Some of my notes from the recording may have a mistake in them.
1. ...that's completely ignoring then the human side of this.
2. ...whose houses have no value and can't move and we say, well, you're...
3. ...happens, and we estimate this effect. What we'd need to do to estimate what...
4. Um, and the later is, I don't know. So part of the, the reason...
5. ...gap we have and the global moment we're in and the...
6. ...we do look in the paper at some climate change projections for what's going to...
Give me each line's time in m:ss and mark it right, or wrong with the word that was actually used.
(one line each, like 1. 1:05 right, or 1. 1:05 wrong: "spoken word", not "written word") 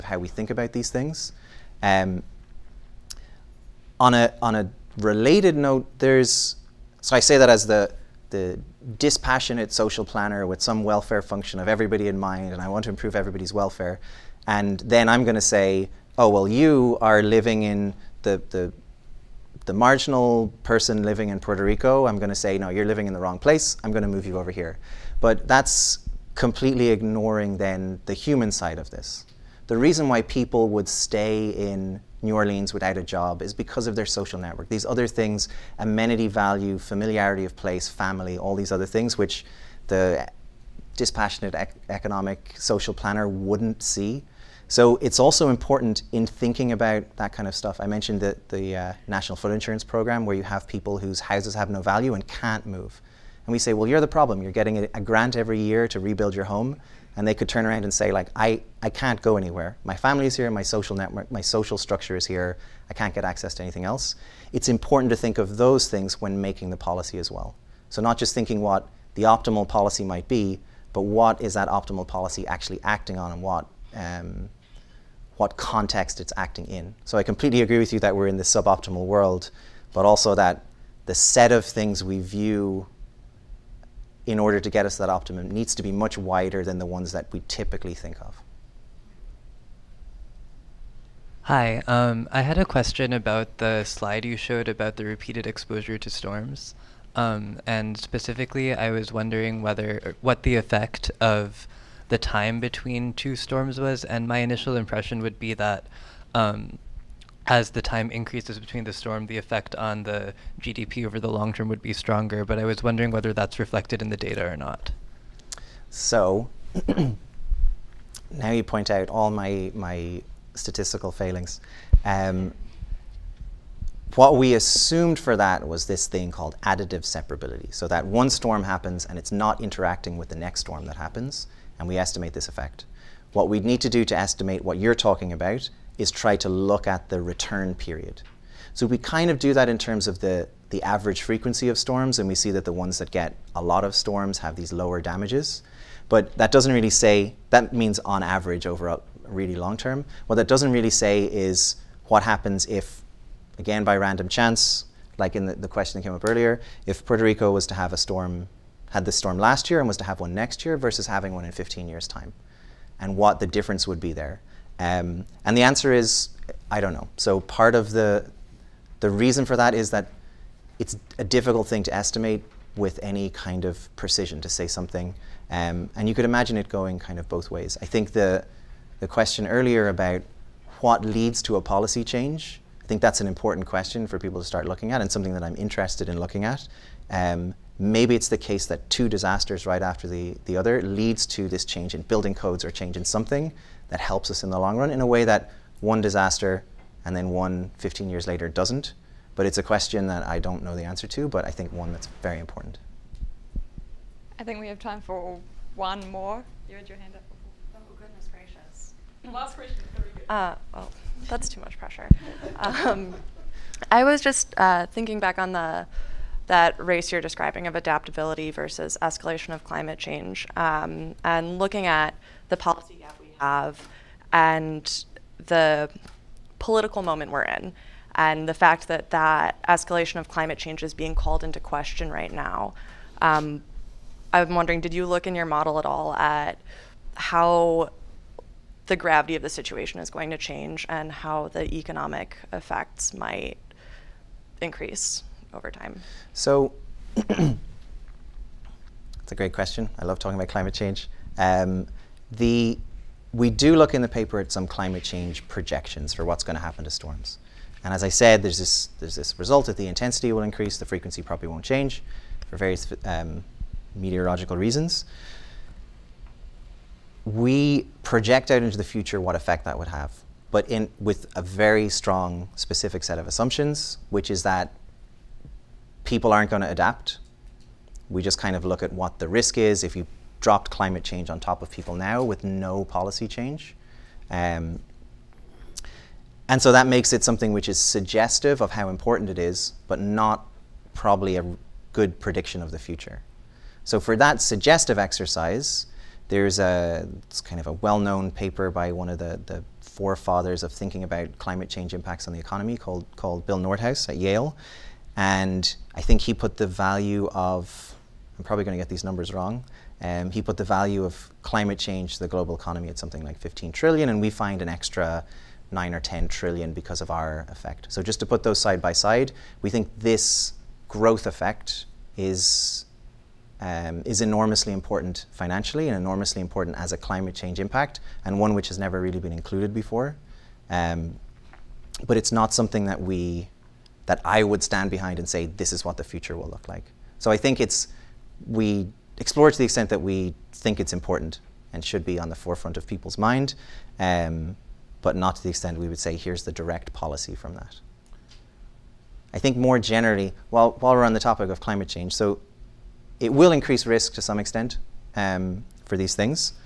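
1. 0:25 right
2. 0:50 right
3. 2:10 right
4. 2:44 wrong: "answer", not "later"
5. 3:42 wrong: "political", not "global"
6. 4:13 right.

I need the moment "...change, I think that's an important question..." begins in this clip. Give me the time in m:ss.
3:02.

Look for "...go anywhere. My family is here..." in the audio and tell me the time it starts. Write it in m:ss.
0:59.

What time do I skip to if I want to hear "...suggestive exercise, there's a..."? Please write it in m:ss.
4:54.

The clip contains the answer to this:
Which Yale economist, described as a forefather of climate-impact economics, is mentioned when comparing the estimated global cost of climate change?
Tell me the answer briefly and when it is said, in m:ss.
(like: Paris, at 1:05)
Bill Nordhaus, at 5:03.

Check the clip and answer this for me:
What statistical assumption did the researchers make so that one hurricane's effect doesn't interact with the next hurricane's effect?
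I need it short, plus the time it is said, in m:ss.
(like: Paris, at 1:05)
additive separability, at 2:06.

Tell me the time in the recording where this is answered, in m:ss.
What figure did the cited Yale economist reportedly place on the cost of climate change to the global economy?
5:13.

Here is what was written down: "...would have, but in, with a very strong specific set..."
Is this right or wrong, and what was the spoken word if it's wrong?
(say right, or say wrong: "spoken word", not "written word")
right.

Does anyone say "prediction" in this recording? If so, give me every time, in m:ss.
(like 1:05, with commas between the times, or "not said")
4:52.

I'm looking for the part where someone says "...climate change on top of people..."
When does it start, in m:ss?
4:40.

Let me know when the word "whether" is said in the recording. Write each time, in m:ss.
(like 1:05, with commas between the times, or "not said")
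1:39, 1:53.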